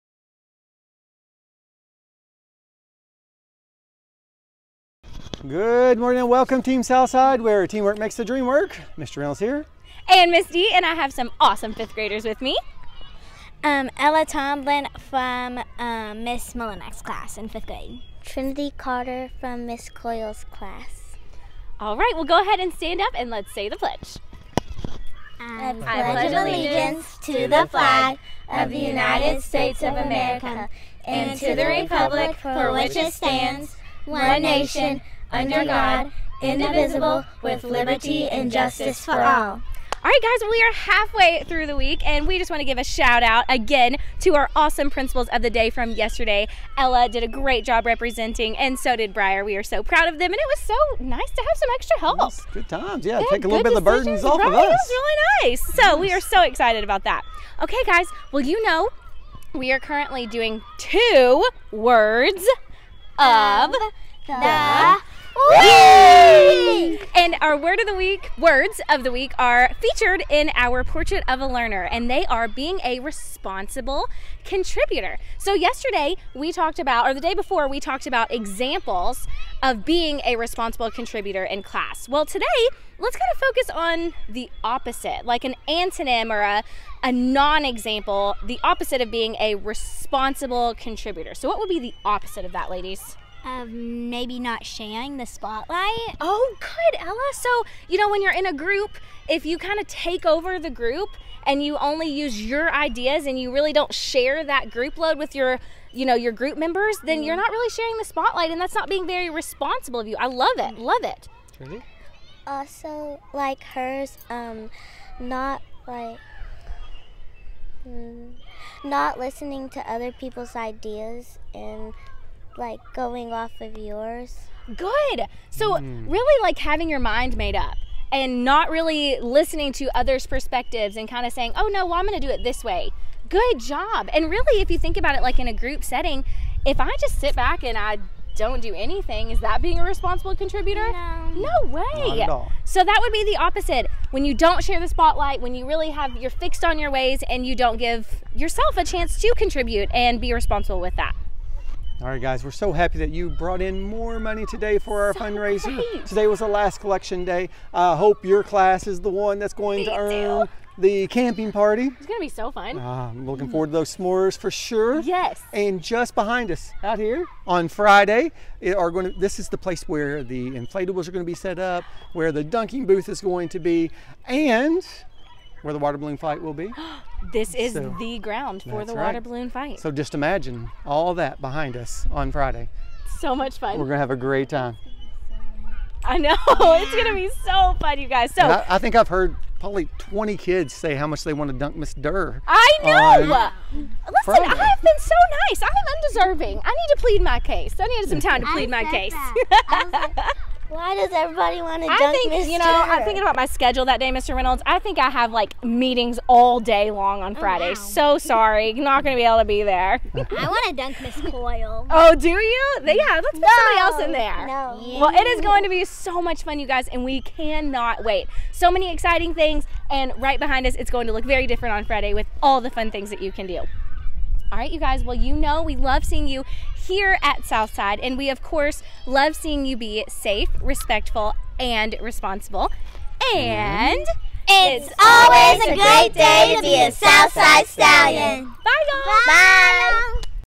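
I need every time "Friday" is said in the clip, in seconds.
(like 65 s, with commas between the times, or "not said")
167 s, 182 s, 194 s, 207 s, 221 s.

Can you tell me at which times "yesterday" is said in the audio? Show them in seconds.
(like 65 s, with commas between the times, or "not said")
45 s, 75 s.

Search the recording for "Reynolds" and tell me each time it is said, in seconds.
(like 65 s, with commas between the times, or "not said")
9 s, 204 s.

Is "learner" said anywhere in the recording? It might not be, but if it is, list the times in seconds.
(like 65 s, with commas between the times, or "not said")
71 s.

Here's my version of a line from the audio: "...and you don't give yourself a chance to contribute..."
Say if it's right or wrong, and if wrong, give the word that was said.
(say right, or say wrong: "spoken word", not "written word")
right.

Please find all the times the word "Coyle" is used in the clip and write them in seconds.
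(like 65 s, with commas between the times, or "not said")
19 s, 211 s.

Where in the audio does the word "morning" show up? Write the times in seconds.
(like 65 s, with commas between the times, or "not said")
5 s.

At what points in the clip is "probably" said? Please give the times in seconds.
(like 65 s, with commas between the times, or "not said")
189 s.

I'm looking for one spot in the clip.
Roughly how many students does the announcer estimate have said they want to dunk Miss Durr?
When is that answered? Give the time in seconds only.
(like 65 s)
189 s.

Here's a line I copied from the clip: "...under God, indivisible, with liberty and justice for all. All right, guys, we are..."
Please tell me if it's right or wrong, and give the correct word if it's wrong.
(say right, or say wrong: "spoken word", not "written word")
right.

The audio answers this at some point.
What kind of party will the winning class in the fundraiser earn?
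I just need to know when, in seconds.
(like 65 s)
160 s.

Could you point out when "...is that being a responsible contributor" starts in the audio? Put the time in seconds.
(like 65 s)
139 s.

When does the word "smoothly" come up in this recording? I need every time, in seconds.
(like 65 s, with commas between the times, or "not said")
not said.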